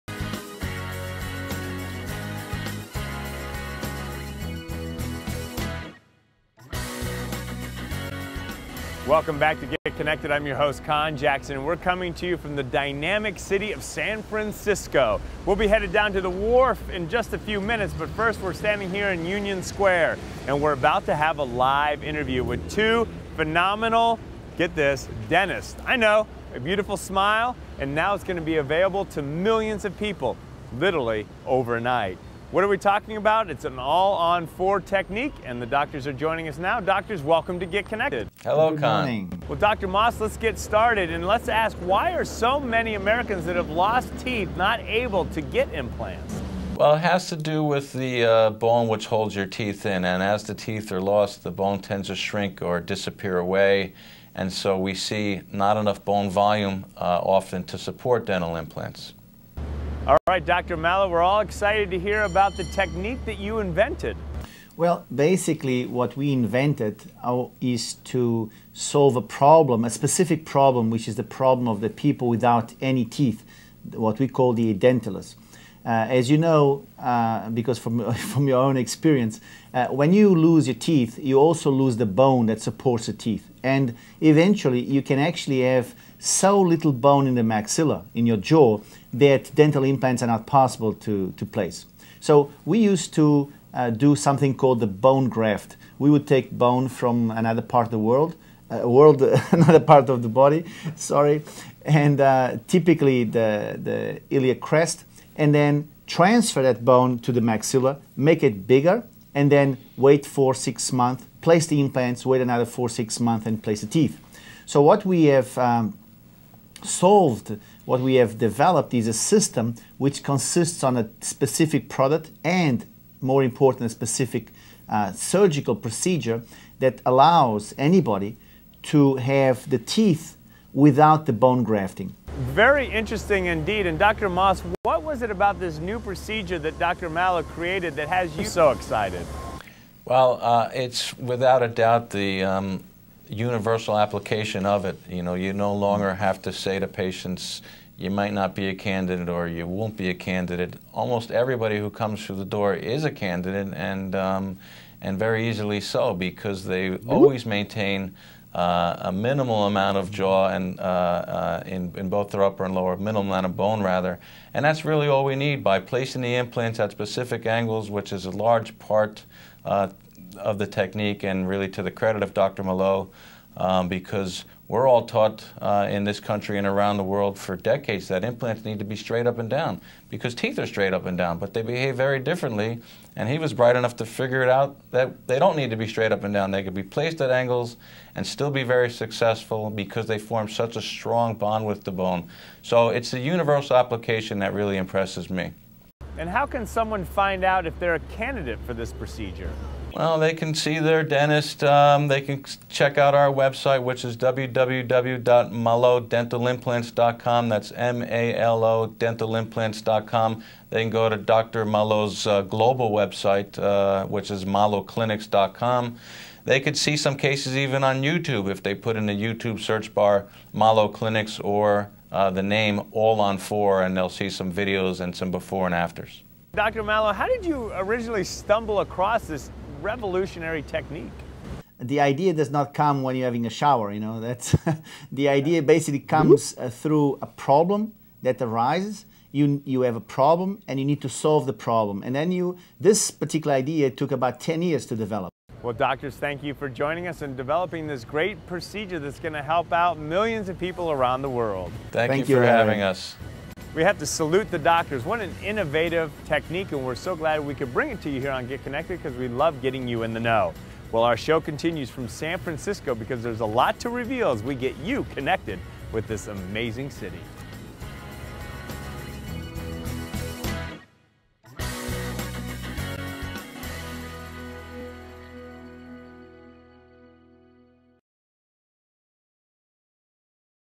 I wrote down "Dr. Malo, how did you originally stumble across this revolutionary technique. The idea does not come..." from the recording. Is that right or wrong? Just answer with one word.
right.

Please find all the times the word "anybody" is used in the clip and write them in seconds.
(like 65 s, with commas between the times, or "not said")
127 s.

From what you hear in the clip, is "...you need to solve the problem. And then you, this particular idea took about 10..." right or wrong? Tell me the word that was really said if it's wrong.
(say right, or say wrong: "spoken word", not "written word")
right.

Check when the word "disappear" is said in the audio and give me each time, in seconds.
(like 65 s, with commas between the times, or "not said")
52 s.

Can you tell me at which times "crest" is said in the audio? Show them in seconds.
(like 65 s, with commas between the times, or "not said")
104 s.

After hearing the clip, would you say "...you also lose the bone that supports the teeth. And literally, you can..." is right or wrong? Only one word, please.
wrong.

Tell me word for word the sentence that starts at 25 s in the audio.
I know, a beautiful smile, and now it's going to be available to millions of people, literally overnight.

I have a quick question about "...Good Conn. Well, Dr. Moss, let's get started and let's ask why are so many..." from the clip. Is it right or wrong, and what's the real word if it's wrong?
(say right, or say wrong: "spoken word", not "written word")
right.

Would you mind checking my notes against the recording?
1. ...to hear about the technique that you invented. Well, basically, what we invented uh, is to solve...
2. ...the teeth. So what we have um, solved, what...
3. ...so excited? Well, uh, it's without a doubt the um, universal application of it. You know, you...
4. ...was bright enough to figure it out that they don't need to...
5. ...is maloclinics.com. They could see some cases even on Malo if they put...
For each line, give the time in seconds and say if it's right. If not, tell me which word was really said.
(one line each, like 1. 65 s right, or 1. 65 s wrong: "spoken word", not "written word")
1. 61 s right
2. 113 s right
3. 138 s right
4. 183 s right
5. 214 s wrong: "YouTube", not "Malo".